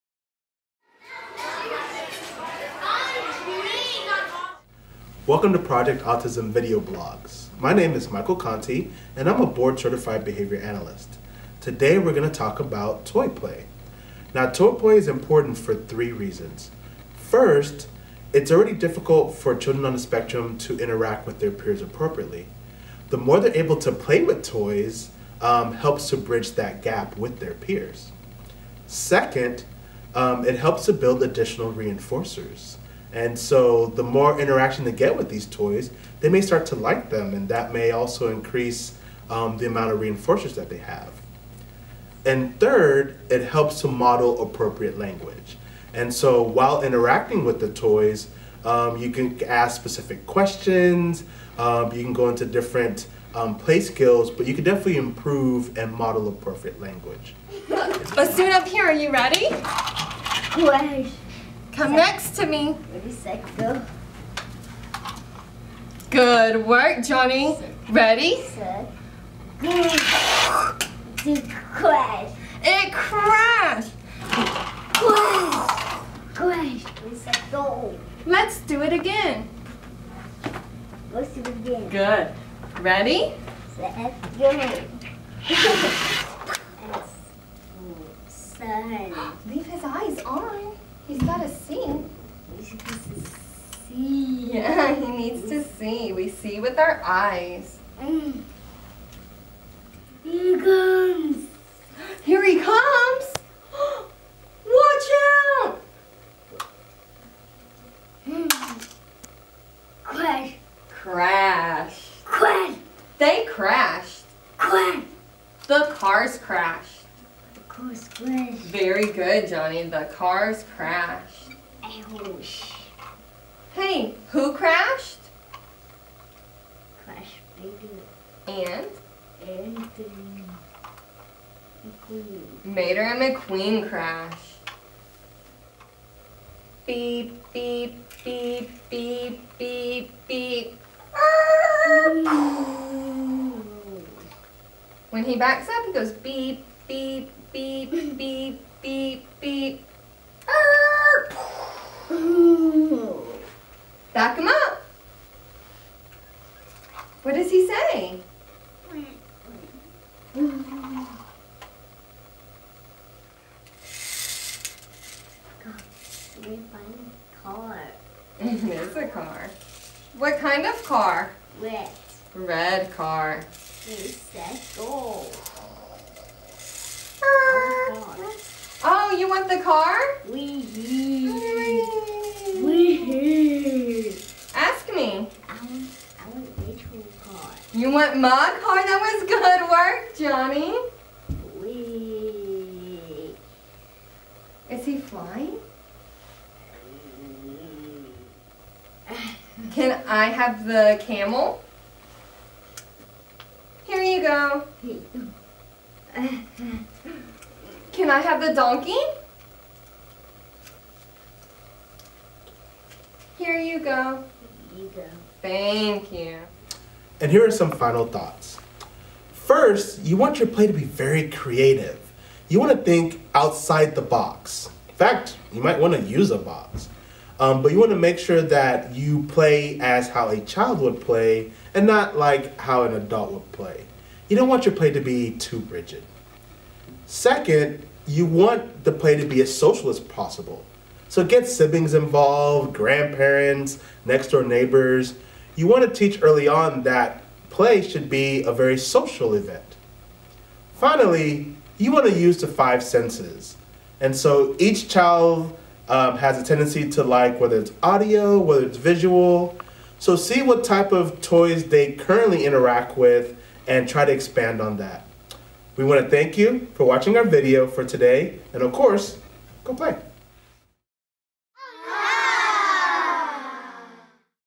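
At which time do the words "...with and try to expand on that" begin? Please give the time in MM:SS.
04:22.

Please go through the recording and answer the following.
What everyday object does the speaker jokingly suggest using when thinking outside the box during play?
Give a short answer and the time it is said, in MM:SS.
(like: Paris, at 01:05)
A box, at 03:46.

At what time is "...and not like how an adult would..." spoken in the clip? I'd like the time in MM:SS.
03:51.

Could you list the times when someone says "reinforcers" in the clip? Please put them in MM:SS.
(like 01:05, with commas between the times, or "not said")
00:31, 00:39.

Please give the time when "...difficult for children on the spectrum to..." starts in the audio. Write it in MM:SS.
00:18.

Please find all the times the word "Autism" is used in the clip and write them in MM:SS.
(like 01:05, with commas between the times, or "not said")
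00:06.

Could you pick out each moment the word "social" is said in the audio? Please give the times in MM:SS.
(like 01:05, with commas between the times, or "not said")
03:59, 04:08.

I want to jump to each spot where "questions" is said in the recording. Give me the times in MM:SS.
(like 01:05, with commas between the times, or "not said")
00:50.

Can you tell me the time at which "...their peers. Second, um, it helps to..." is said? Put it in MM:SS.
00:27.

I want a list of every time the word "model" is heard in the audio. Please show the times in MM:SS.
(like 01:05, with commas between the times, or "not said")
00:43, 00:55.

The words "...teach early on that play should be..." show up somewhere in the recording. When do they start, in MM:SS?
04:05.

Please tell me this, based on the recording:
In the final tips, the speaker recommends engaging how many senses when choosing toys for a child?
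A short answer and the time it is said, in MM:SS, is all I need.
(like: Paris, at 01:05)
5, at 04:12.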